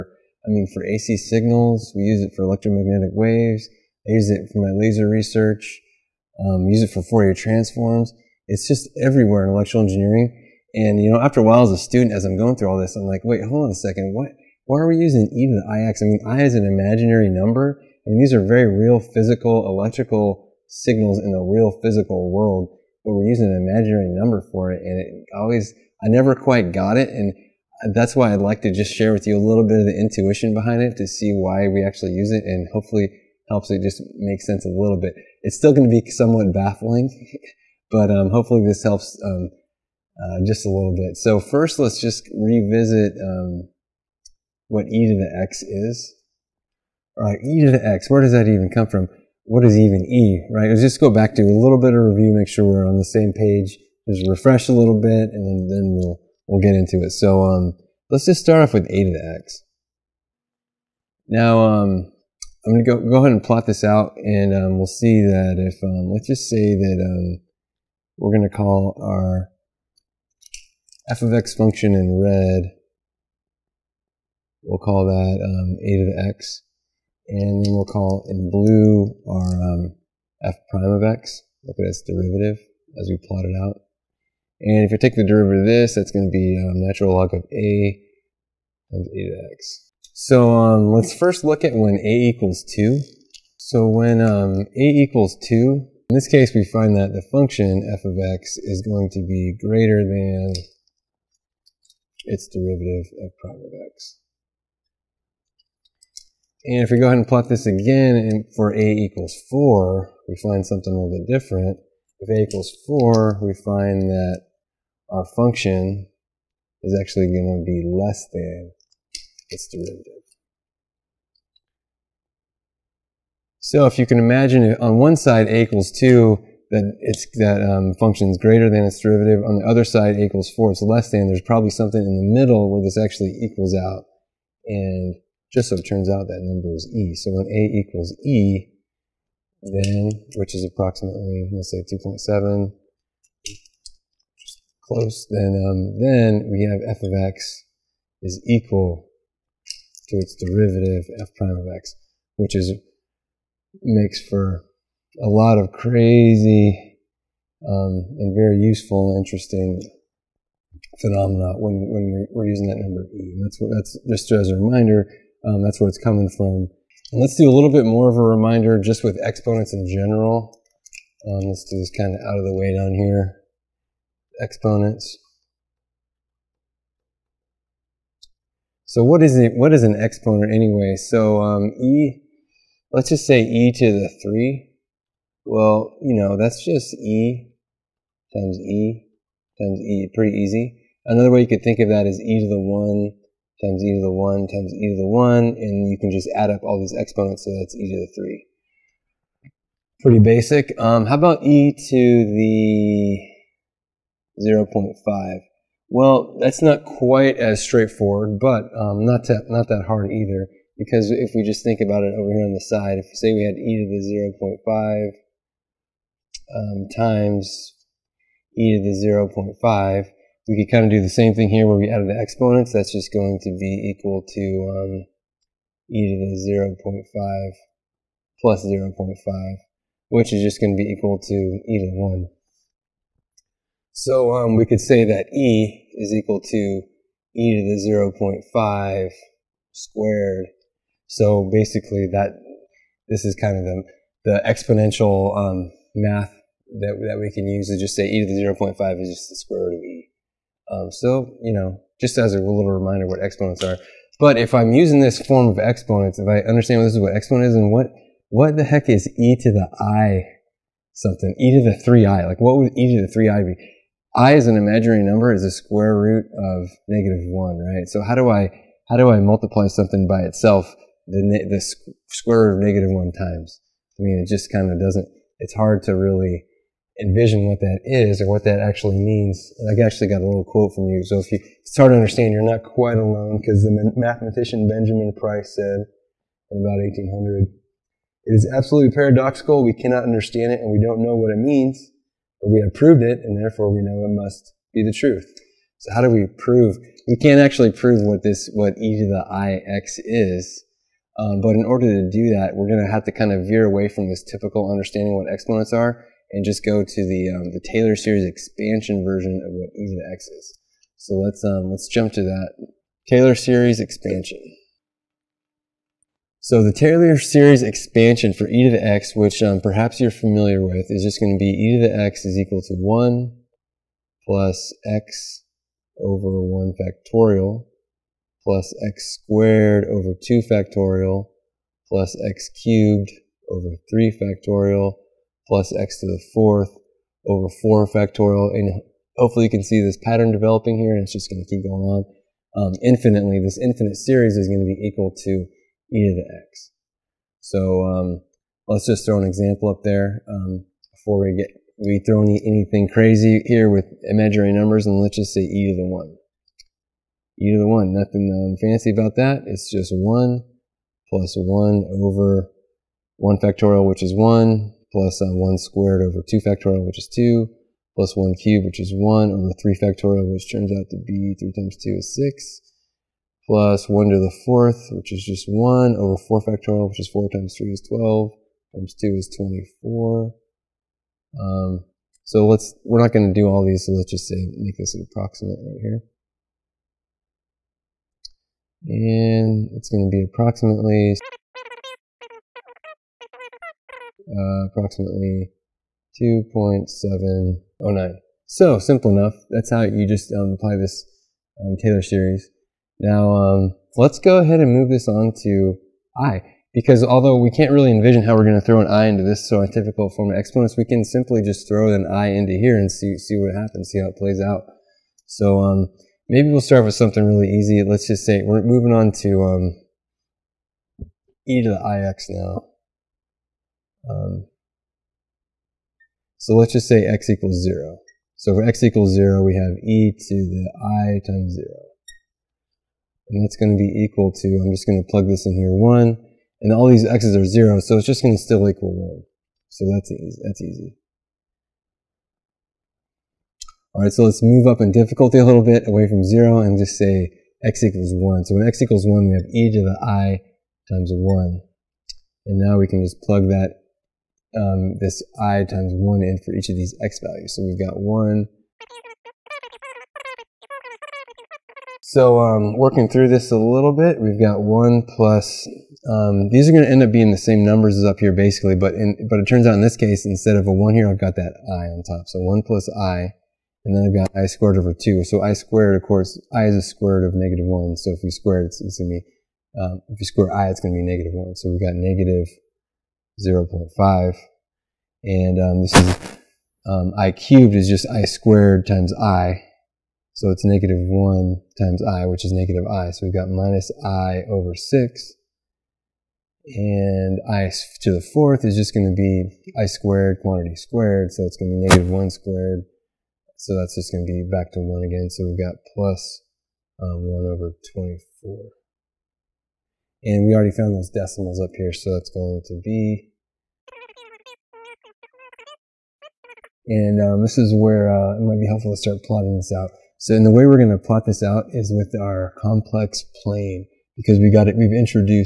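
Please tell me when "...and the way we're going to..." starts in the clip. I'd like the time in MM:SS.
08:40.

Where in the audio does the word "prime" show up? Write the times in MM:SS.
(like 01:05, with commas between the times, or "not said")
01:20, 01:43, 02:31.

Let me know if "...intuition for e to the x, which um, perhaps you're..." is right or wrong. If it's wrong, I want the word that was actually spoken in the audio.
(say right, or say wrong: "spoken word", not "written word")
wrong: "expansion", not "intuition".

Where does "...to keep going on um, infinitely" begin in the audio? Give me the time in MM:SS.
05:41.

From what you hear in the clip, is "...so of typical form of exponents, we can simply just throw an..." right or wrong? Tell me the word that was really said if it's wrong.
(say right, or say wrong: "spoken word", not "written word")
right.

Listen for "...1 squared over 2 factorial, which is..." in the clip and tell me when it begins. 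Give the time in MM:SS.
06:05.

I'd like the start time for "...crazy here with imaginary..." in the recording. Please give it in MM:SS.
05:52.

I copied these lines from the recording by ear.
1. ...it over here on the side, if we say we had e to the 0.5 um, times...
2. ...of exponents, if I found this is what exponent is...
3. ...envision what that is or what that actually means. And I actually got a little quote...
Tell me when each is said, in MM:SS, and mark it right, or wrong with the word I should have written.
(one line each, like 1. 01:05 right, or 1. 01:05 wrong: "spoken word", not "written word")
1. 03:32 right
2. 04:15 wrong: "understand", not "found"
3. 04:37 right.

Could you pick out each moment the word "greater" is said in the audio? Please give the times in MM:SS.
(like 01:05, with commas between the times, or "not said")
01:39, 02:08.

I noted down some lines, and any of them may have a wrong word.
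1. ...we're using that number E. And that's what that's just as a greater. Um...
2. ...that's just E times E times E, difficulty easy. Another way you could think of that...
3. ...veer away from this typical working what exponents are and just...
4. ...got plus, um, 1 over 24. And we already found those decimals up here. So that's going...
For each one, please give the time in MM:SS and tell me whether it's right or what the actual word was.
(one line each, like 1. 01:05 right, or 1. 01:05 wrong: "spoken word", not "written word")
1. 02:42 wrong: "reminder", not "greater"
2. 03:06 wrong: "pretty", not "difficulty"
3. 05:03 wrong: "understanding", not "working"
4. 08:25 right.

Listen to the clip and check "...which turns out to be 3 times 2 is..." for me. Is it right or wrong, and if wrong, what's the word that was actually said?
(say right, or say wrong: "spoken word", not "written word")
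right.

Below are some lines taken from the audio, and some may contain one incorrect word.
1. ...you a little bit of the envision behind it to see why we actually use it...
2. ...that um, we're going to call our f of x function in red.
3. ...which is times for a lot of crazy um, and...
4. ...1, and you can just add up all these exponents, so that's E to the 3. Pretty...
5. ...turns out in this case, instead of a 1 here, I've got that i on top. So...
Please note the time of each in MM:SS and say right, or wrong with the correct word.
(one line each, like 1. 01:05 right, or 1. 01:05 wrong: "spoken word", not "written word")
1. 00:29 wrong: "intuition", not "envision"
2. 01:06 right
3. 02:32 wrong: "makes", not "times"
4. 03:15 right
5. 07:49 right.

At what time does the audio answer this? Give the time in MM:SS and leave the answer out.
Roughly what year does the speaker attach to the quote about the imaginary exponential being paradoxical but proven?
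04:46.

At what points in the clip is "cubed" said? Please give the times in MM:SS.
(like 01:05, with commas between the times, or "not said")
05:32, 06:08, 08:07.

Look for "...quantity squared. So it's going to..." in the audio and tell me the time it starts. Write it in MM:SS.
08:20.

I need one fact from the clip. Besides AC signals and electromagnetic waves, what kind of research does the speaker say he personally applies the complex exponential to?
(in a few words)
laser research.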